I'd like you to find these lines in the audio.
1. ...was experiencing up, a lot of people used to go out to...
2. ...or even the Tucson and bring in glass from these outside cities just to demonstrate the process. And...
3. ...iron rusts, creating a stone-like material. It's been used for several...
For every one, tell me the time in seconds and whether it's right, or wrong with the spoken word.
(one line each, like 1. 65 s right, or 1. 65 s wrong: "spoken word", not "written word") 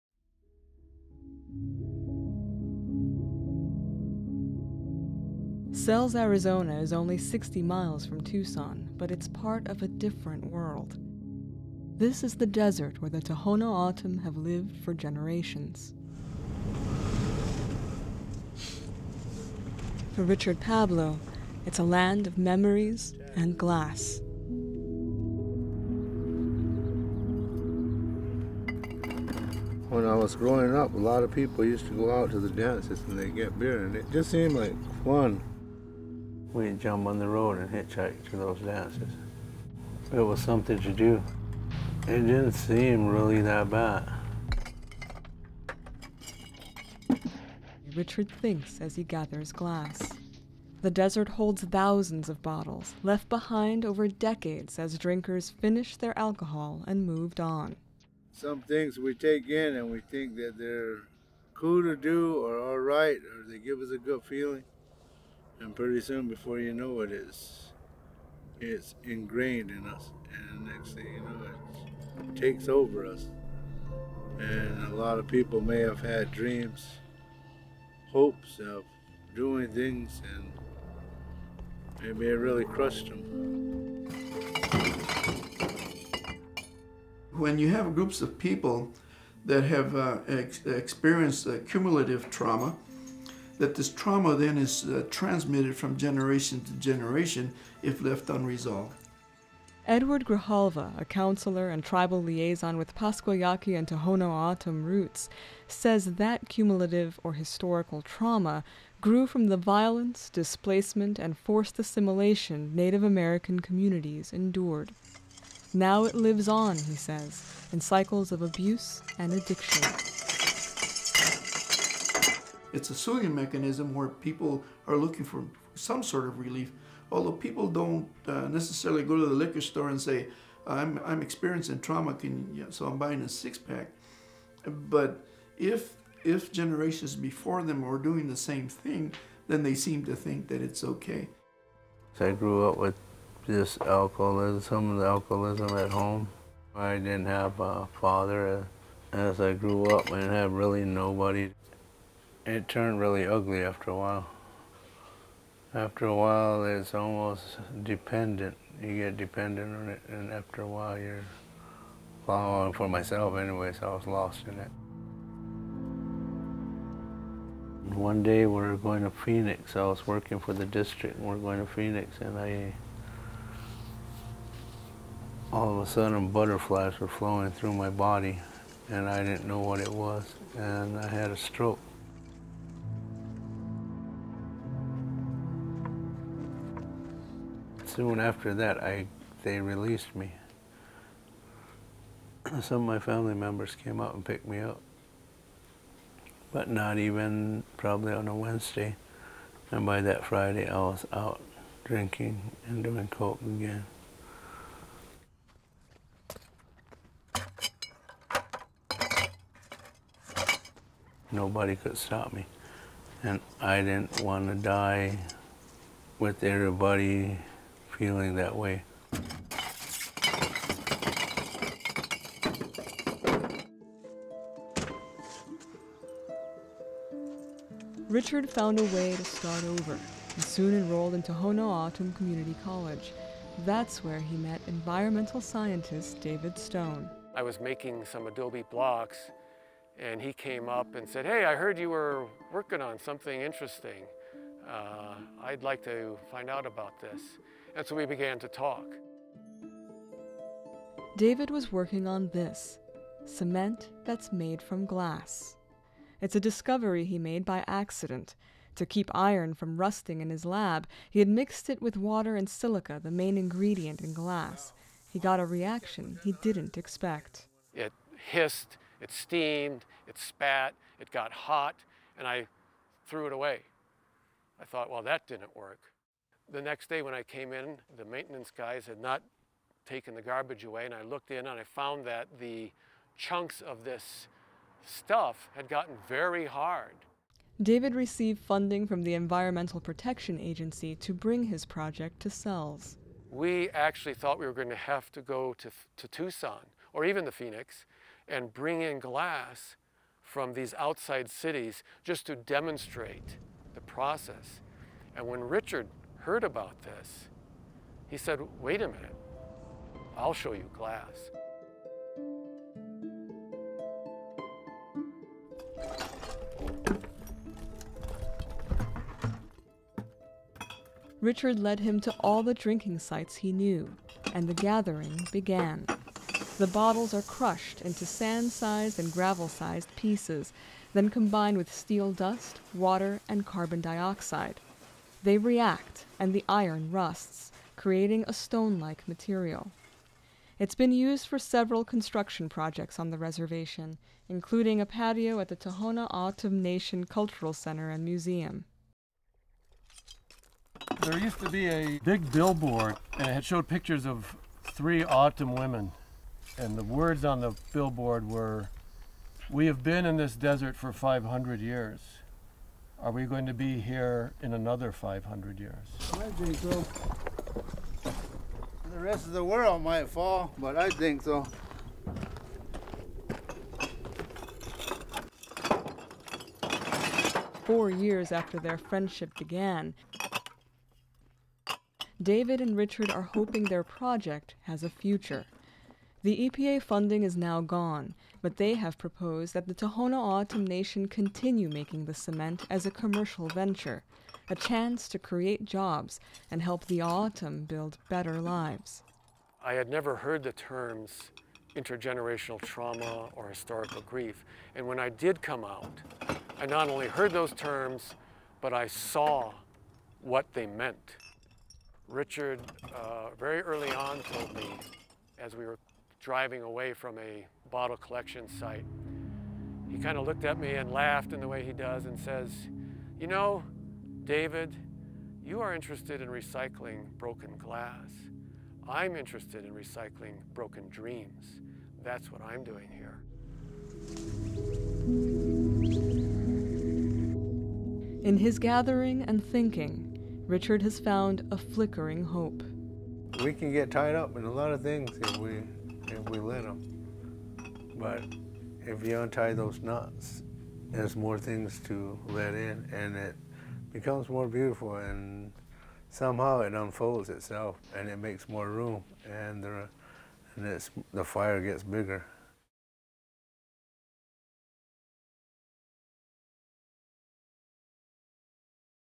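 1. 30 s wrong: "growing", not "experiencing"
2. 296 s wrong: "Phoenix", not "Tucson"
3. 336 s right.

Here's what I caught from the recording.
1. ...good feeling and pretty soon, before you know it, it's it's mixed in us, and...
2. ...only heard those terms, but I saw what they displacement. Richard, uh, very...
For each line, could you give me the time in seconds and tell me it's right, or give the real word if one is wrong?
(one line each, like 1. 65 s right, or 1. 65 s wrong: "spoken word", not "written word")
1. 63 s wrong: "ingrained", not "mixed"
2. 406 s wrong: "meant", not "displacement".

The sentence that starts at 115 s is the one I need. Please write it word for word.
Now it lives on, he says, in cycles of abuse and addiction.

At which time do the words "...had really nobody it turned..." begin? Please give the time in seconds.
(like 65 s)
150 s.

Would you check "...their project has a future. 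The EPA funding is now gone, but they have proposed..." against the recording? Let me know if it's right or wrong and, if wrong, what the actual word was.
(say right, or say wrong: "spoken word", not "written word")
right.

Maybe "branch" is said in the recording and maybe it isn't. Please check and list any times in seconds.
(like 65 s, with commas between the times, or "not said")
not said.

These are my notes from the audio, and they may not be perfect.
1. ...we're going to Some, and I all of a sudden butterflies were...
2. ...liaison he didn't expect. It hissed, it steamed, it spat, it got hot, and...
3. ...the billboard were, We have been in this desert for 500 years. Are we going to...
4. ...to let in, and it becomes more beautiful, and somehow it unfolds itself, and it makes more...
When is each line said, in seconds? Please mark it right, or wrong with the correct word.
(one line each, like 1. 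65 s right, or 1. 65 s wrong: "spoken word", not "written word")
1. 171 s wrong: "Phoenix", not "Some"
2. 265 s wrong: "reaction", not "liaison"
3. 357 s right
4. 451 s right.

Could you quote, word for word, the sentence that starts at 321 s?
Richard led him to all the drinking sites he knew, and the gathering began.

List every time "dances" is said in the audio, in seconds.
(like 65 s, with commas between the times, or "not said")
32 s, 38 s.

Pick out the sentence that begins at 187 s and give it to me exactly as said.
soon after that, I they released me.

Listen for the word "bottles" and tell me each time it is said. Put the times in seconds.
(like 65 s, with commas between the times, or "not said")
52 s, 326 s, 417 s.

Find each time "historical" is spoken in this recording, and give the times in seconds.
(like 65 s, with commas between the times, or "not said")
107 s, 403 s.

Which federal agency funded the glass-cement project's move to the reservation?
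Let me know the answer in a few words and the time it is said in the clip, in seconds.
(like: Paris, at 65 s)
Environmental Protection Agency, at 289 s.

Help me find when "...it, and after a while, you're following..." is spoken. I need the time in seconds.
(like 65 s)
159 s.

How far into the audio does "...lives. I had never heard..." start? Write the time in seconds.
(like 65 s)
398 s.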